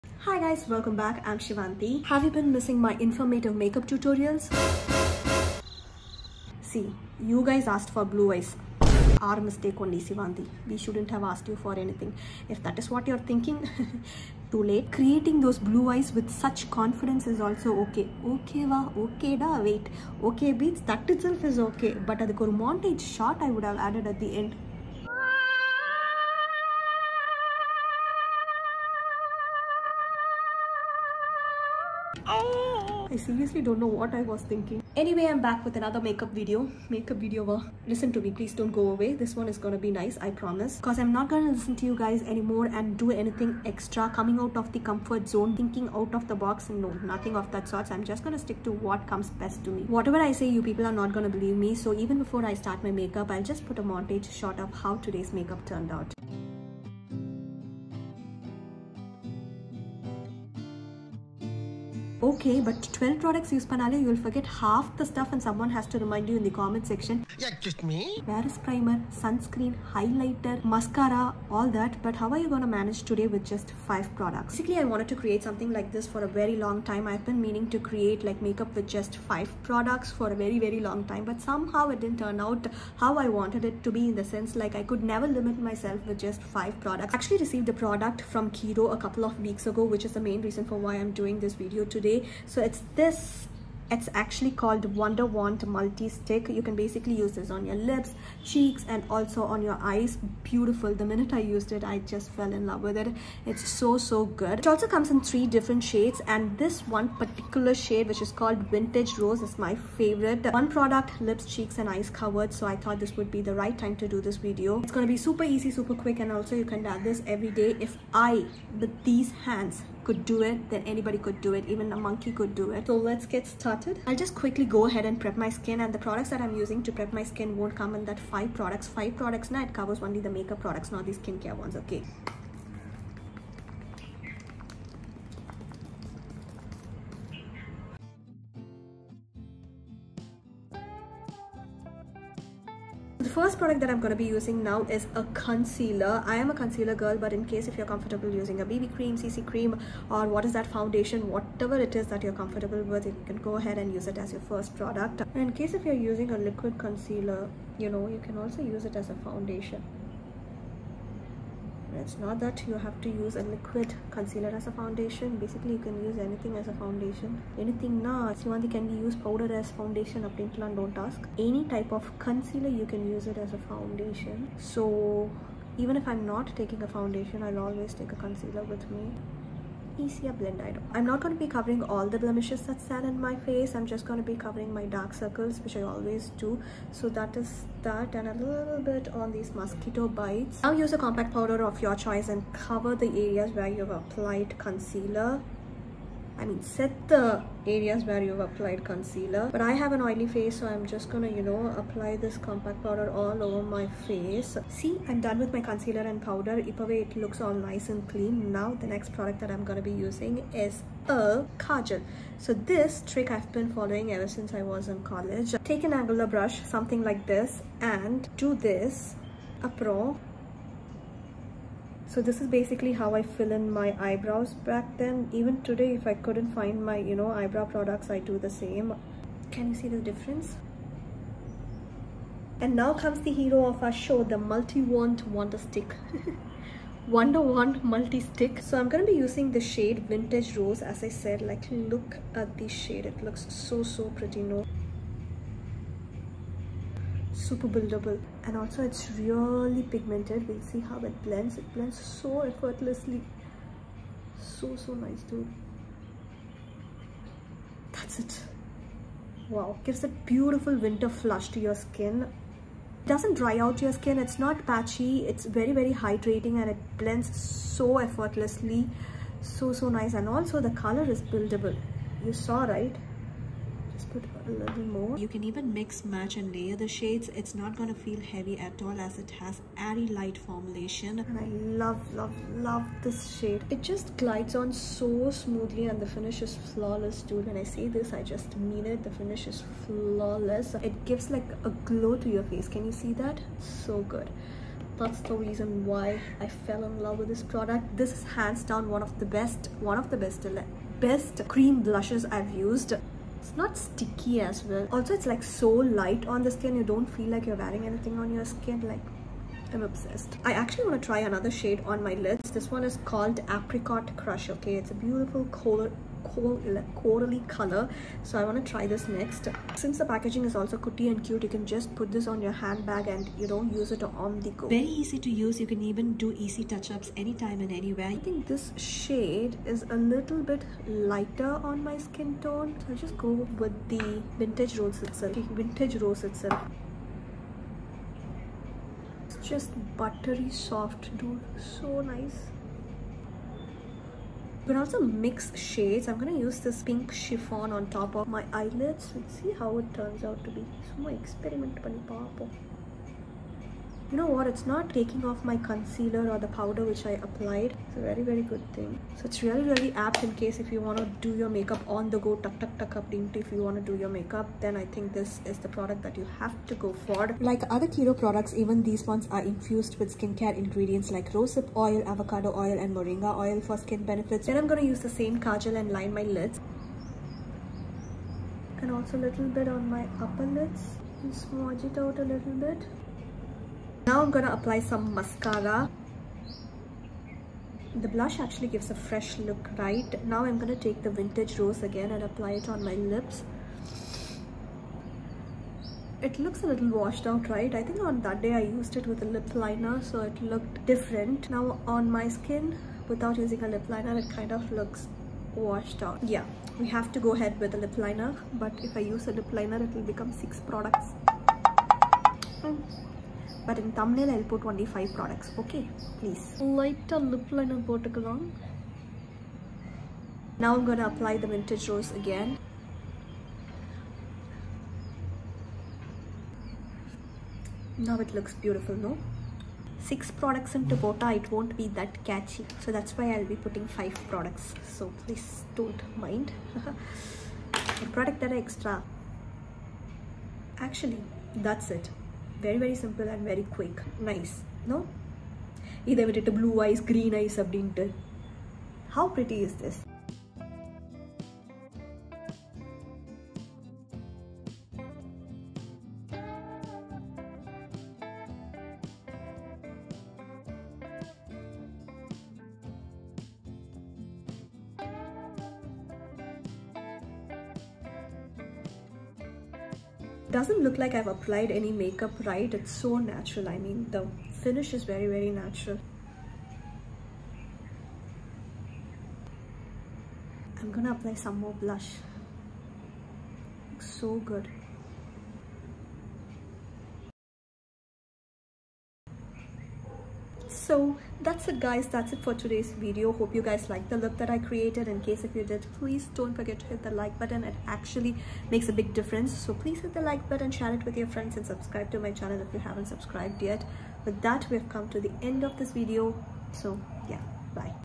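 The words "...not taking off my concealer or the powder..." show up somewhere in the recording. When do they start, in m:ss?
5:54.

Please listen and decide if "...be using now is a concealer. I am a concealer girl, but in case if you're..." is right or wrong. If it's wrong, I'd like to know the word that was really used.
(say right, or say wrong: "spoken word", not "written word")
right.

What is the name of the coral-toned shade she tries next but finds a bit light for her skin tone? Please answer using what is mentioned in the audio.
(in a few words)
Apricot Crush.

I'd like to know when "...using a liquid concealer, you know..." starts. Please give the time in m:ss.
2:36.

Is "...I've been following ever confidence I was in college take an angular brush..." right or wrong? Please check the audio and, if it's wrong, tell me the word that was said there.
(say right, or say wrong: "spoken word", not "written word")
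wrong: "since", not "confidence".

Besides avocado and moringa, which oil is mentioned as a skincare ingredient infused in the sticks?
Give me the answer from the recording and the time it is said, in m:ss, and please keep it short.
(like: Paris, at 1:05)
Rosehip oil, at 6:11.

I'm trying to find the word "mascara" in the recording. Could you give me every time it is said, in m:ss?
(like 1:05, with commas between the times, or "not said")
1:10, 6:25.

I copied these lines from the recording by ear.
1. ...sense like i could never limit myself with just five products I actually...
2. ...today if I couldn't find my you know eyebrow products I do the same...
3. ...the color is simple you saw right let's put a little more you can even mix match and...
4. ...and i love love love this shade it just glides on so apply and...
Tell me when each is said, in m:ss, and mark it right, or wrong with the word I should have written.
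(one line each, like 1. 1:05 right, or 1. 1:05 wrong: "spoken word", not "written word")
1. 1:24 right
2. 3:45 right
3. 4:30 wrong: "buildable", not "simple"
4. 4:41 wrong: "smoothly", not "apply".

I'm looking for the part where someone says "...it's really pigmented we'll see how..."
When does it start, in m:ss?
4:08.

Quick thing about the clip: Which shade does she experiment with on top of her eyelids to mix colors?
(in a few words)
Pink Chiffon.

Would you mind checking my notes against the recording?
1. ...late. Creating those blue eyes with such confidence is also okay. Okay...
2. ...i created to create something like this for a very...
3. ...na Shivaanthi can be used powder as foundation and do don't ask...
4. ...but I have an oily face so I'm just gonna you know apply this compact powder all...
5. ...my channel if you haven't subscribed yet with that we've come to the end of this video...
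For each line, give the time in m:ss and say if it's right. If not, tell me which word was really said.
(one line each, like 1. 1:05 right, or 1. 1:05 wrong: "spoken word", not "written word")
1. 0:14 right
2. 1:14 wrong: "wanted", not "created"
3. 2:48 right
4. 3:19 right
5. 8:22 right.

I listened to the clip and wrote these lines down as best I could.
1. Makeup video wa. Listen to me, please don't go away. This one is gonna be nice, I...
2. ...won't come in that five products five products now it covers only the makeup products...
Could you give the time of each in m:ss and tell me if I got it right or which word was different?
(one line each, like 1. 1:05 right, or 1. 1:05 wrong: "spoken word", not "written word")
1. 0:36 right
2. 2:07 right.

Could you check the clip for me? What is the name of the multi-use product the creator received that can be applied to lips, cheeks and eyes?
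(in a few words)
Wonder Wand Multi Stick.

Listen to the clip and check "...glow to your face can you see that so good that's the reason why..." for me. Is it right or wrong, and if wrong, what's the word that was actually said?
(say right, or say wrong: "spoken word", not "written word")
right.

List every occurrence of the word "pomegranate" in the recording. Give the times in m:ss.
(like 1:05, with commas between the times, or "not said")
not said.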